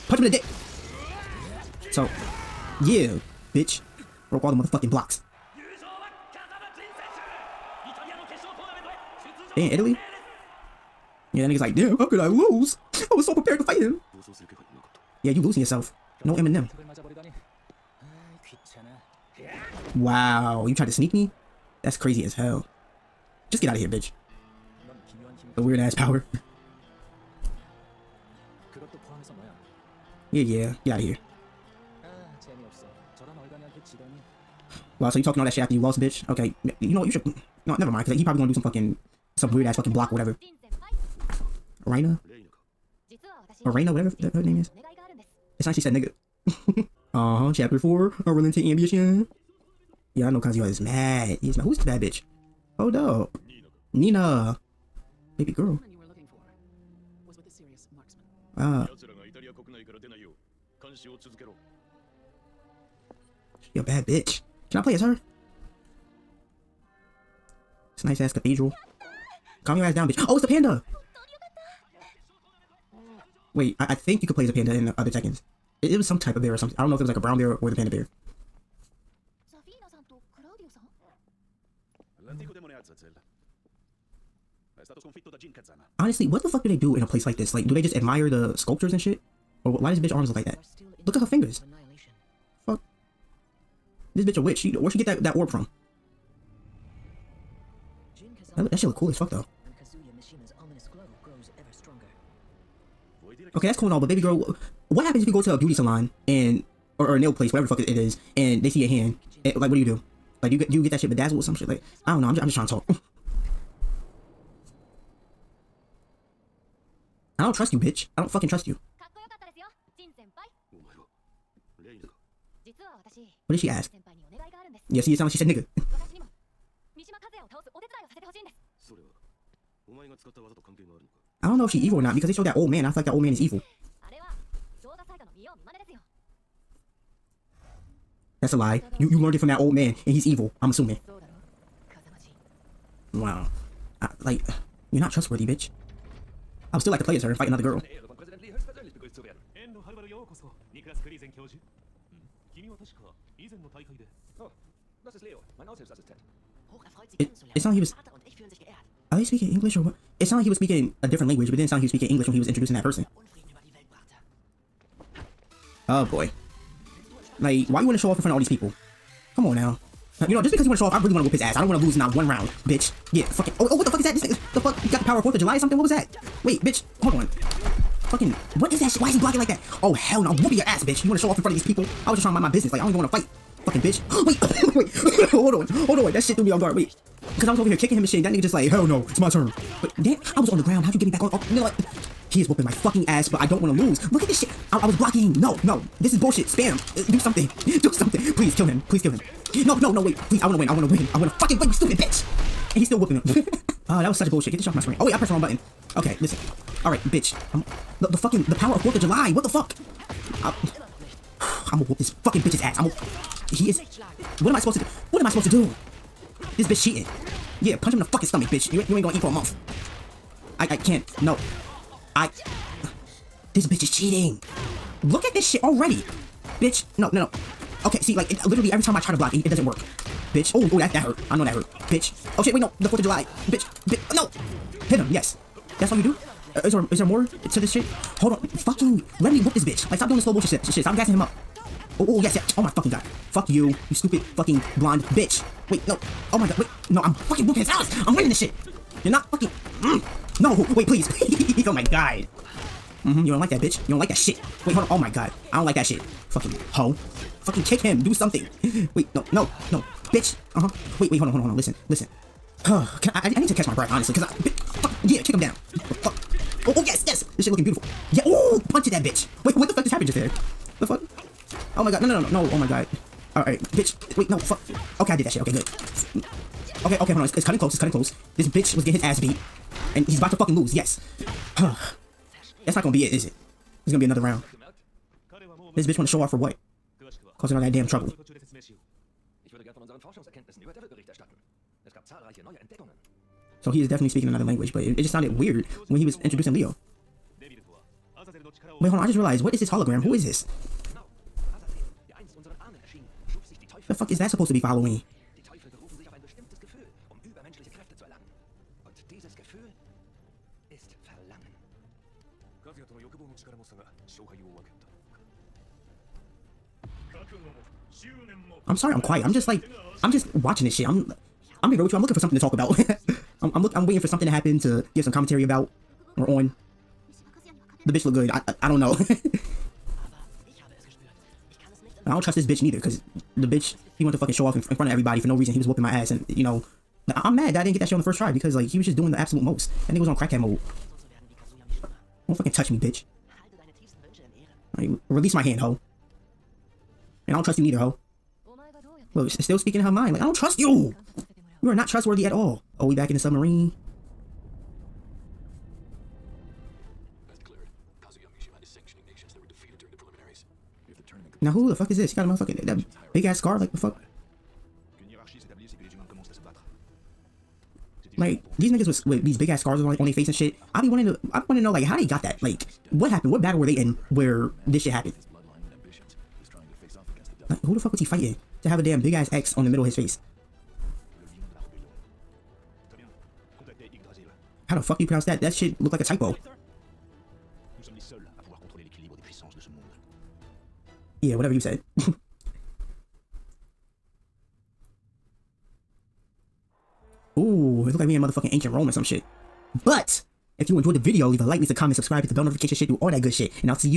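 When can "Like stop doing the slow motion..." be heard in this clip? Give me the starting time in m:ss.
3:59.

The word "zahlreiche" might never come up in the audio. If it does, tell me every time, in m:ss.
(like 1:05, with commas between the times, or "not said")
4:52.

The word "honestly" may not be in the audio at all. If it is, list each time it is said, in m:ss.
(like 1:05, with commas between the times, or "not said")
1:25, 4:23.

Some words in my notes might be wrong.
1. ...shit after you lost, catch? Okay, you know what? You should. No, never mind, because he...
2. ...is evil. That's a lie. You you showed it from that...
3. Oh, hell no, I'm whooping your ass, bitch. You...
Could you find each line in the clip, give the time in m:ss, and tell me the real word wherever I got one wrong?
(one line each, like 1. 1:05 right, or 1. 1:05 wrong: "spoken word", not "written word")
1. 0:35 wrong: "bitch", not "catch"
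2. 2:13 wrong: "learned", not "showed"
3. 2:59 right.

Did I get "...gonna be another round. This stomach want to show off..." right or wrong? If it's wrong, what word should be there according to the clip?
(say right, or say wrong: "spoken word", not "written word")
wrong: "bitch", not "stomach".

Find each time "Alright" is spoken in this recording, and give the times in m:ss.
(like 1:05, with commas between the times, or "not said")
4:33.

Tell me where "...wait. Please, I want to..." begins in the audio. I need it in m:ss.
3:20.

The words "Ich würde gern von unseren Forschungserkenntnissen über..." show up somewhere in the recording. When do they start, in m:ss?
4:49.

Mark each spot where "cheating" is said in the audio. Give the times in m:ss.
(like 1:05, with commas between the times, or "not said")
3:36, 3:43.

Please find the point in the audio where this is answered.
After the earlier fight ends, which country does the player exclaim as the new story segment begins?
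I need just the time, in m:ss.
0:09.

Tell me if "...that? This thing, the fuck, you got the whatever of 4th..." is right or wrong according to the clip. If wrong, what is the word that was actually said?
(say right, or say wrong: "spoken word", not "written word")
wrong: "power", not "whatever".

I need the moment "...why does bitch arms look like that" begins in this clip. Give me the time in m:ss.
1:29.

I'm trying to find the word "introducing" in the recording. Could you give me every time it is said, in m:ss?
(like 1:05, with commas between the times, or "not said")
2:42, 4:56.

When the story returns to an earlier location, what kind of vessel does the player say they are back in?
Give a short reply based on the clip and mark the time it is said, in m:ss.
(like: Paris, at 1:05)
Submarine, at 5:53.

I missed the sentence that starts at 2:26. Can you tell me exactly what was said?
I would still like to play as her and fight another girl.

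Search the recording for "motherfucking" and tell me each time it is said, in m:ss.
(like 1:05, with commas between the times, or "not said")
0:04, 6:02, 6:38.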